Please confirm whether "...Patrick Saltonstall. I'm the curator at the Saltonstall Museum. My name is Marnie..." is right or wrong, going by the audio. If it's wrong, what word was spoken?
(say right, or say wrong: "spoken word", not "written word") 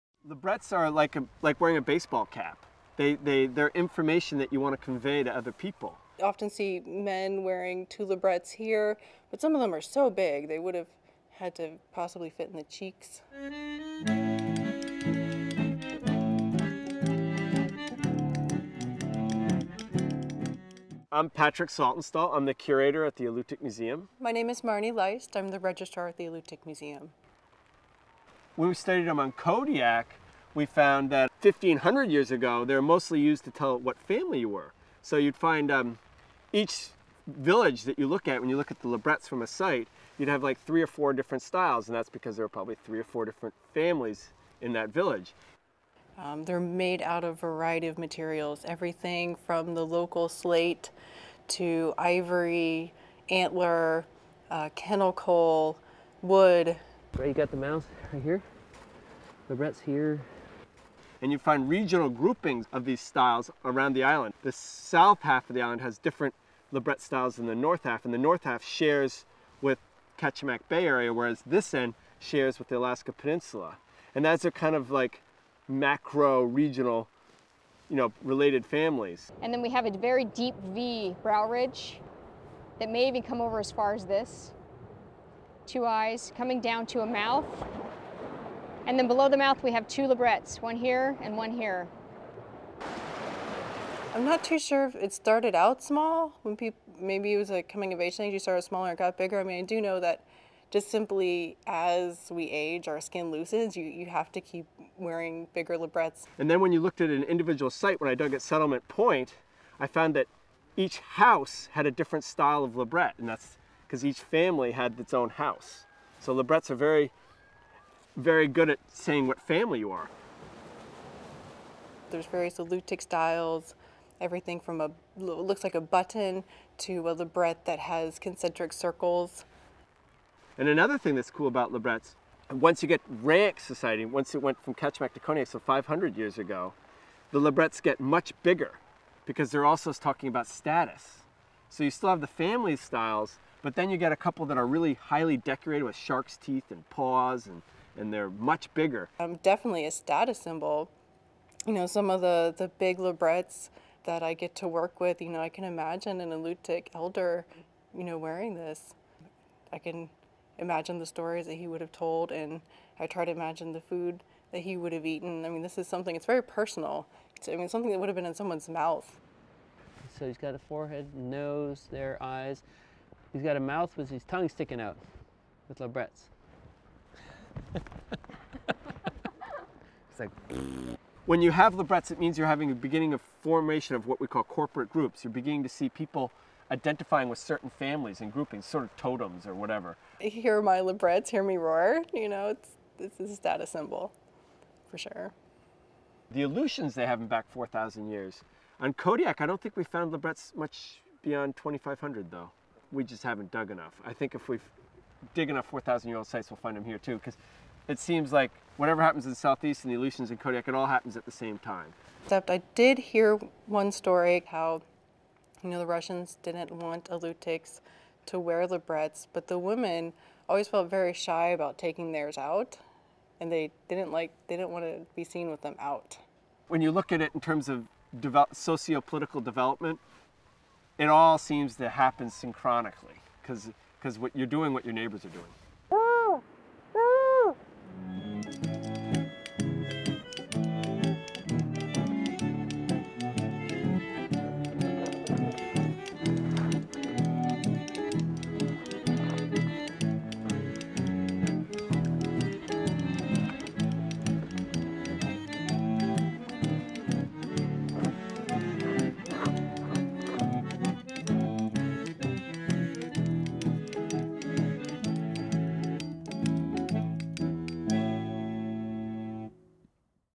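wrong: "Alutiiq", not "Saltonstall".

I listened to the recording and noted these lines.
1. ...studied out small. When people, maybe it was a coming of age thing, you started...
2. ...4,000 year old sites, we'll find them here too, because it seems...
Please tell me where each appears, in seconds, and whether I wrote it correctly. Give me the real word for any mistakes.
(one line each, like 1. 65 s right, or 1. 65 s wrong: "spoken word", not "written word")
1. 95 s wrong: "started", not "studied"
2. 205 s right.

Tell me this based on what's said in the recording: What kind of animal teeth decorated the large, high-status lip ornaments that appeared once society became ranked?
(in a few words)
Shark's teeth.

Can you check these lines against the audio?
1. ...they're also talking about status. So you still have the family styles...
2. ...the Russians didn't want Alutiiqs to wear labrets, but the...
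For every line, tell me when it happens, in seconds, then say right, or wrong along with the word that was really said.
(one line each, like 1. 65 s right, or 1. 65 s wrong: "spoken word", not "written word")
1. 139 s right
2. 215 s right.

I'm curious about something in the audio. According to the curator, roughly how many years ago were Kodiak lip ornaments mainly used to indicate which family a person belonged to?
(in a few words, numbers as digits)
1500 years.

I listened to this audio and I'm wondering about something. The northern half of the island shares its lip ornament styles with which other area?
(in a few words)
Kachemak Bay.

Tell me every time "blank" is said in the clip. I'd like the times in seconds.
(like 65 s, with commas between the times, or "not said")
not said.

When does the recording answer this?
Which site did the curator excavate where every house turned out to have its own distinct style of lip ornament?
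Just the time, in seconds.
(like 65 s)
108 s.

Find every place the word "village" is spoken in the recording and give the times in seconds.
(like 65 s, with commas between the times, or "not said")
37 s, 44 s.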